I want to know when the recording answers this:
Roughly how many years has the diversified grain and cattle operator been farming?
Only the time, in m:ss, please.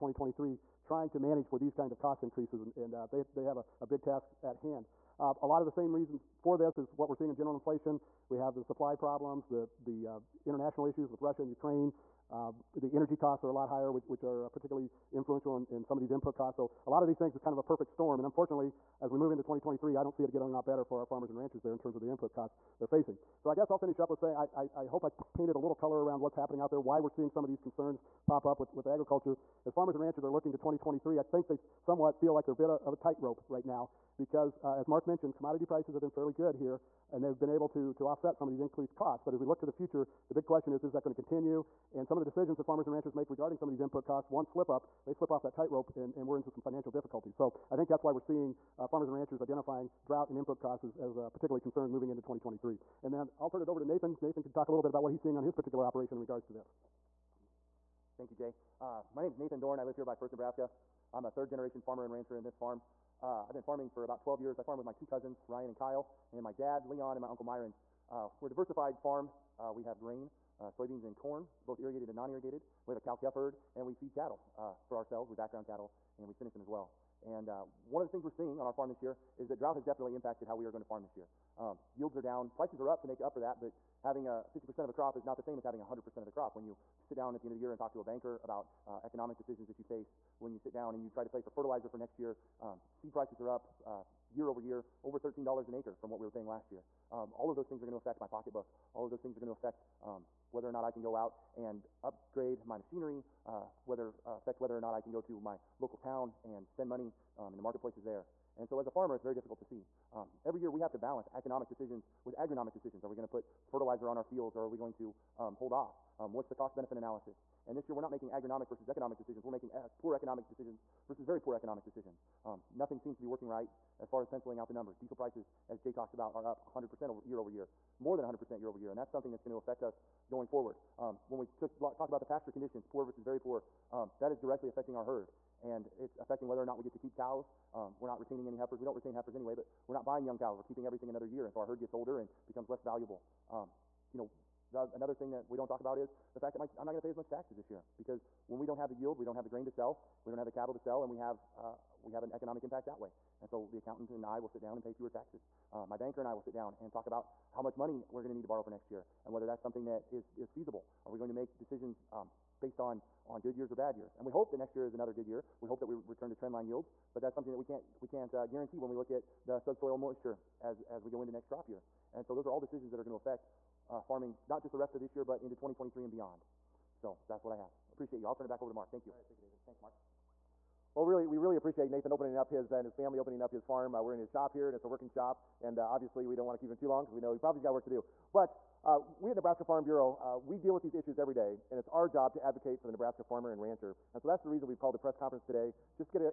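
1:04.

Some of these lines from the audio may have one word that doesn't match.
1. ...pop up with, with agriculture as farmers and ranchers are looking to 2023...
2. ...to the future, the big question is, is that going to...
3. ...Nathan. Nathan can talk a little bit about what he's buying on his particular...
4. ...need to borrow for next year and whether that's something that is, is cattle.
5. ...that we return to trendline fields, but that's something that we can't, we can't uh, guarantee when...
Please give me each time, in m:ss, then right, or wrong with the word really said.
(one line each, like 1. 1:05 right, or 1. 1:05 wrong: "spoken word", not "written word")
1. 0:28 right
2. 0:39 right
3. 0:53 wrong: "seeing", not "buying"
4. 2:38 wrong: "feasible", not "cattle"
5. 2:45 wrong: "yields", not "fields".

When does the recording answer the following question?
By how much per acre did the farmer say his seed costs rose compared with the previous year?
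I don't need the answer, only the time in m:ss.
1:35.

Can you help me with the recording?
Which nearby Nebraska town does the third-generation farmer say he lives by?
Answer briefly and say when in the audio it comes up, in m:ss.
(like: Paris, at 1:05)
Firth, at 1:00.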